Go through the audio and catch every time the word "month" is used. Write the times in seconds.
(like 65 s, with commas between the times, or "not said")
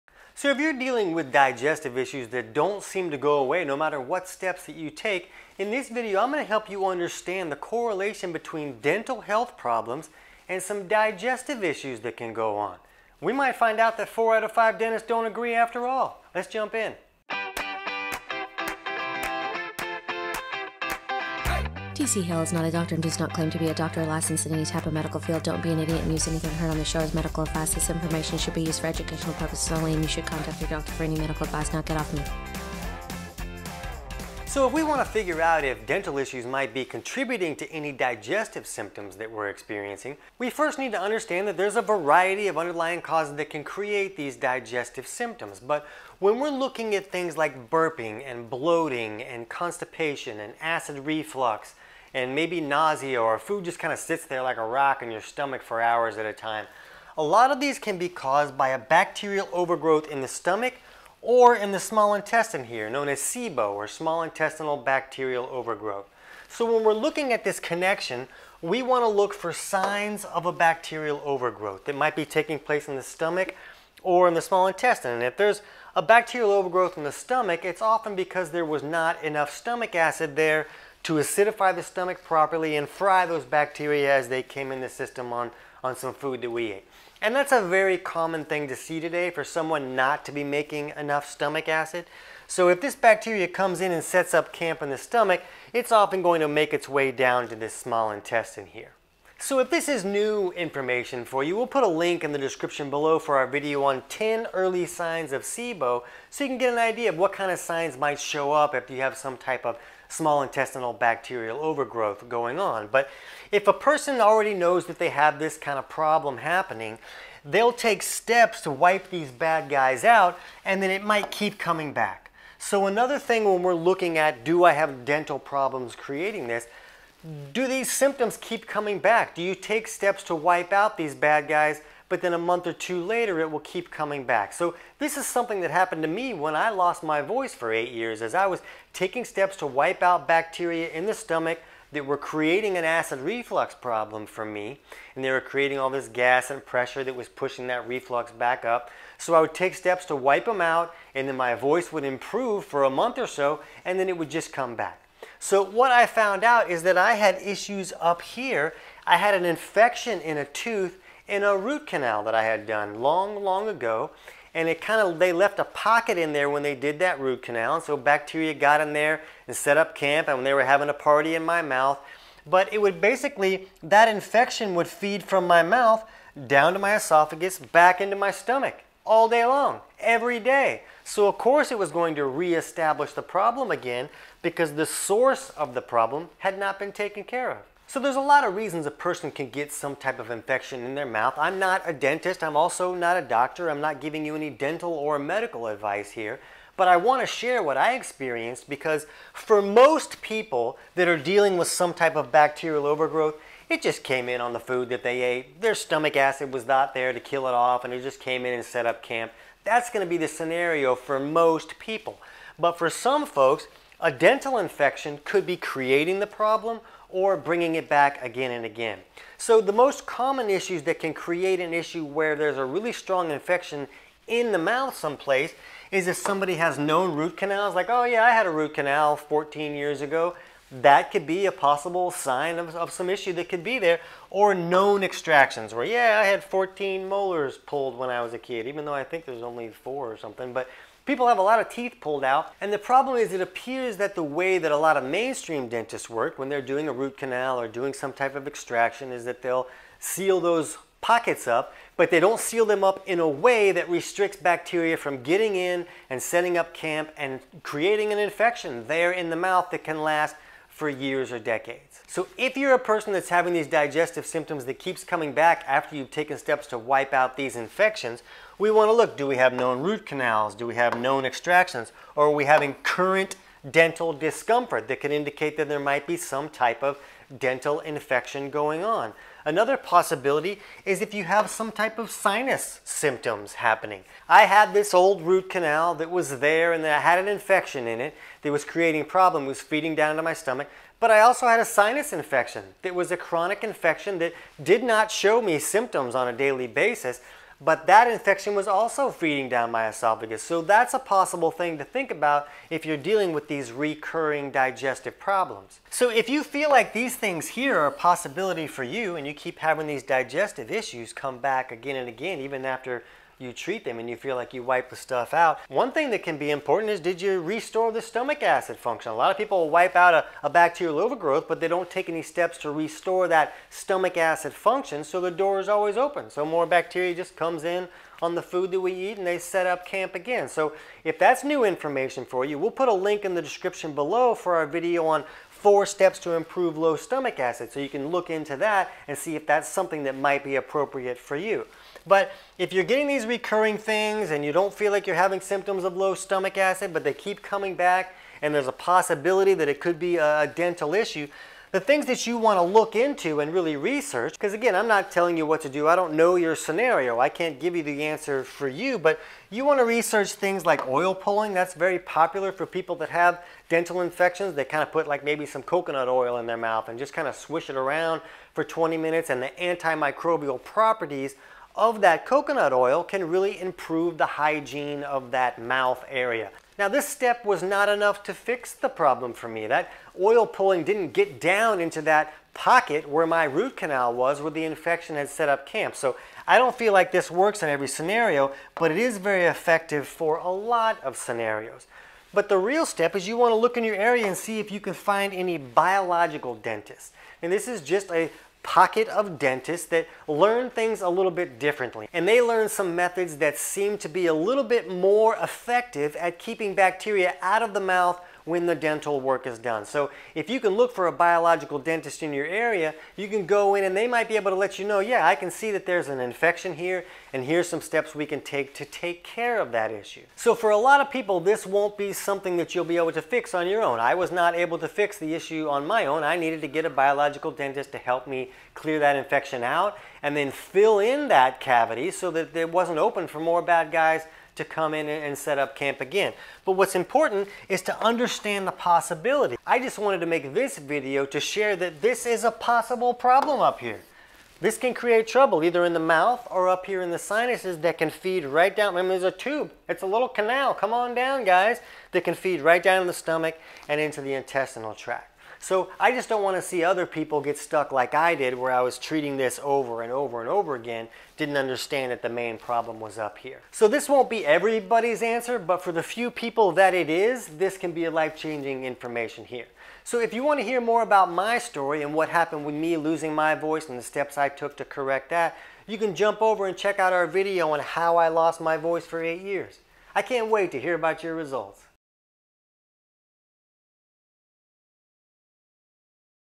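132 s, 152 s.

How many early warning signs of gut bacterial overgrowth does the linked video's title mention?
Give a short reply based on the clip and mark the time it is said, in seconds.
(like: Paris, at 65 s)
10, at 104 s.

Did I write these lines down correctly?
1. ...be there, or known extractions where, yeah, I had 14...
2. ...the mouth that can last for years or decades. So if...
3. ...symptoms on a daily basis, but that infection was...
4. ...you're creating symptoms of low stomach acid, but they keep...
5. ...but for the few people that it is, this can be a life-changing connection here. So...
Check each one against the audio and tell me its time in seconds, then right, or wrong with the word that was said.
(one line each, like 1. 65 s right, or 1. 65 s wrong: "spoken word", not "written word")
1. 233 s right
2. 259 s right
3. 295 s right
4. 345 s wrong: "having", not "creating"
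5. 465 s wrong: "information", not "connection".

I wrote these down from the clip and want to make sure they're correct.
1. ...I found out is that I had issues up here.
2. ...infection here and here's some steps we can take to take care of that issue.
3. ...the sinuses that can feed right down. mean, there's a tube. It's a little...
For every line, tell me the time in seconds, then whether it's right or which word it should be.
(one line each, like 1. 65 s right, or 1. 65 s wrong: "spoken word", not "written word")
1. 155 s right
2. 416 s right
3. 447 s right.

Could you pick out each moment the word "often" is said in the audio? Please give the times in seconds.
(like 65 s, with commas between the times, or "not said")
77 s, 95 s.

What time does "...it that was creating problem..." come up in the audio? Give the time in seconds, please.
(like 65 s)
287 s.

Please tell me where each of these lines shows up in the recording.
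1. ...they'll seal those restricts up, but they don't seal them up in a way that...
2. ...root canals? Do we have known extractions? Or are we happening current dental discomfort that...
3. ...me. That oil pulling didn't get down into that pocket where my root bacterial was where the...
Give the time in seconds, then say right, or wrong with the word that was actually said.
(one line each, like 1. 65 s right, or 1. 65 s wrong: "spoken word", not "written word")
1. 249 s wrong: "pockets", not "restricts"
2. 269 s wrong: "having", not "happening"
3. 379 s wrong: "canal", not "bacterial".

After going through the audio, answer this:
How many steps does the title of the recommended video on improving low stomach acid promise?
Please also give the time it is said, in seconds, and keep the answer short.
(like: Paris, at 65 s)
4, at 335 s.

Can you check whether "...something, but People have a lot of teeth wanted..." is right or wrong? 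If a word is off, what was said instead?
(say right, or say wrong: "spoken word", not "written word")
wrong: "pulled", not "wanted".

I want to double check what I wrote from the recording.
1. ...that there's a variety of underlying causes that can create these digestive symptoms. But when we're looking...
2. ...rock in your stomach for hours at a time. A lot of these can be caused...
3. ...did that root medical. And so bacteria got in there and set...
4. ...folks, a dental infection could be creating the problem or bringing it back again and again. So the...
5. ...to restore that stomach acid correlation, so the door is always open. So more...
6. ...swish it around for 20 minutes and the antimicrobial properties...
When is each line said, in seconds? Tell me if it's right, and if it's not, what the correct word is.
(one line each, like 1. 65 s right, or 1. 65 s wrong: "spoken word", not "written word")
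1. 41 s right
2. 54 s right
3. 166 s wrong: "canal", not "medical"
4. 213 s right
5. 322 s wrong: "function", not "correlation"
6. 367 s right.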